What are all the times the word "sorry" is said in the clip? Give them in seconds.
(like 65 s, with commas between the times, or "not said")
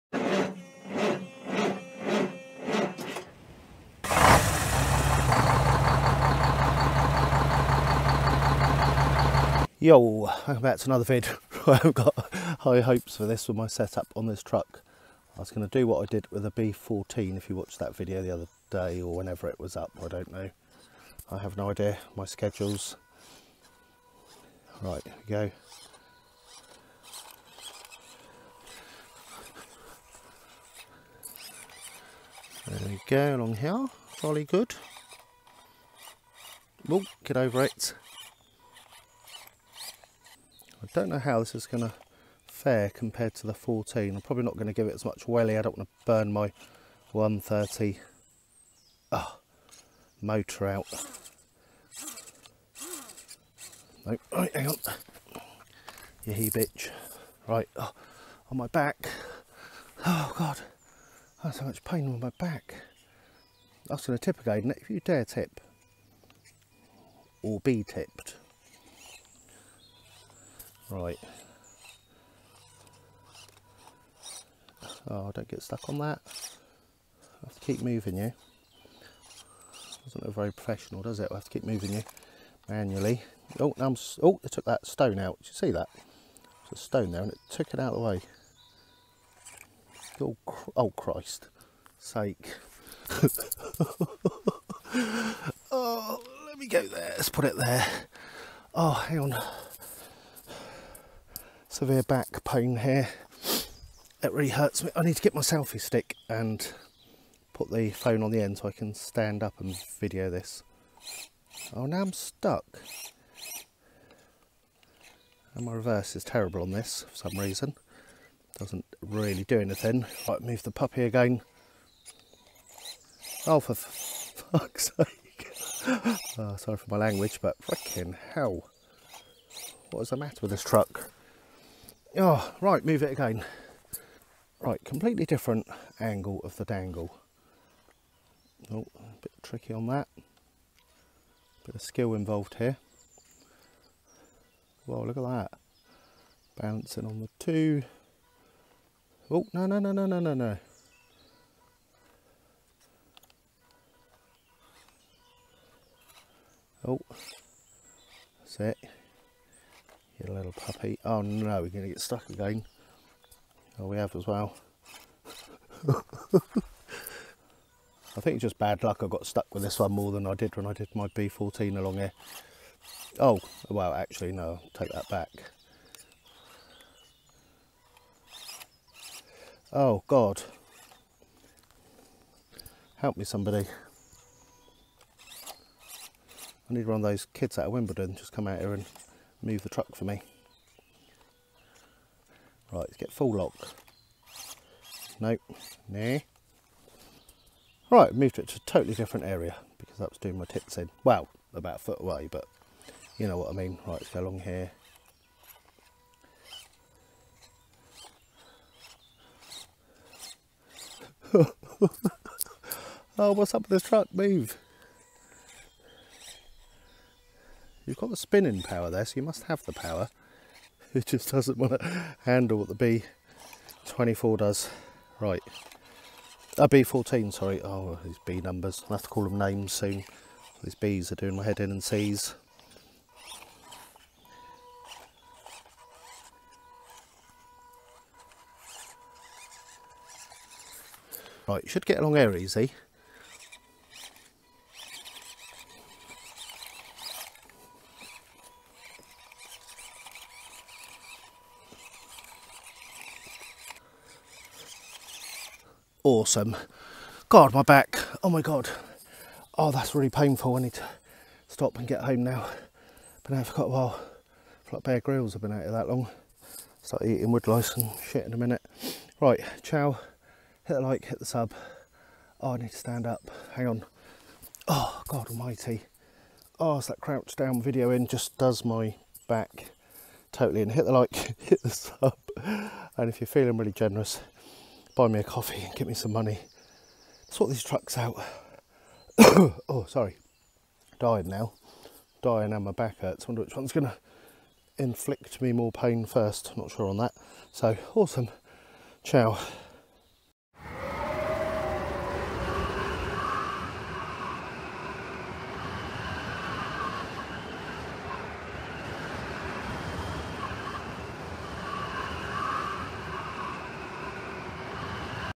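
126 s, 227 s, 289 s.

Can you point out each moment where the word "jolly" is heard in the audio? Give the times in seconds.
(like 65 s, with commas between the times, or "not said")
34 s.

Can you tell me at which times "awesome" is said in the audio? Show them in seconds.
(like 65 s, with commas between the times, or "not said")
256 s, 297 s.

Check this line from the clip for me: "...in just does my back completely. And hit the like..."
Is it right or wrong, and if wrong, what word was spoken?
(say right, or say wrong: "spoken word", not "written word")
wrong: "totally", not "completely".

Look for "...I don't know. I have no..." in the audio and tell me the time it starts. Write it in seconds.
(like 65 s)
20 s.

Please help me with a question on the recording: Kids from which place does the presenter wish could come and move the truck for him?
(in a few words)
Wimbledon.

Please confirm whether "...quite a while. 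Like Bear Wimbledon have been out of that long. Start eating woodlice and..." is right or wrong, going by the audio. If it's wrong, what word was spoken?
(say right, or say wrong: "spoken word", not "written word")
wrong: "Grylls", not "Wimbledon".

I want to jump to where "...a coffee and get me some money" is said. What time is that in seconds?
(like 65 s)
285 s.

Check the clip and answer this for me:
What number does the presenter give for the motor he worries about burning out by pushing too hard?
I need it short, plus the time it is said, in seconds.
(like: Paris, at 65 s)
130, at 47 s.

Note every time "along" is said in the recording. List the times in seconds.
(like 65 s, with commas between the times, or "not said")
33 s, 171 s, 204 s, 241 s.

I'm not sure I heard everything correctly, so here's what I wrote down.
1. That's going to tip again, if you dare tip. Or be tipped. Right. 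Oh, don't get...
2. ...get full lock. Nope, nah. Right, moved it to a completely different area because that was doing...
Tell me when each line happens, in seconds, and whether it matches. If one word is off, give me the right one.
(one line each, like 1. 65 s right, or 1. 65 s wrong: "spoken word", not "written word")
1. 63 s right
2. 192 s wrong: "totally", not "completely".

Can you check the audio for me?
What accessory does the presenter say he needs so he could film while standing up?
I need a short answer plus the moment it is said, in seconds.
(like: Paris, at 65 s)
selfie stick, at 105 s.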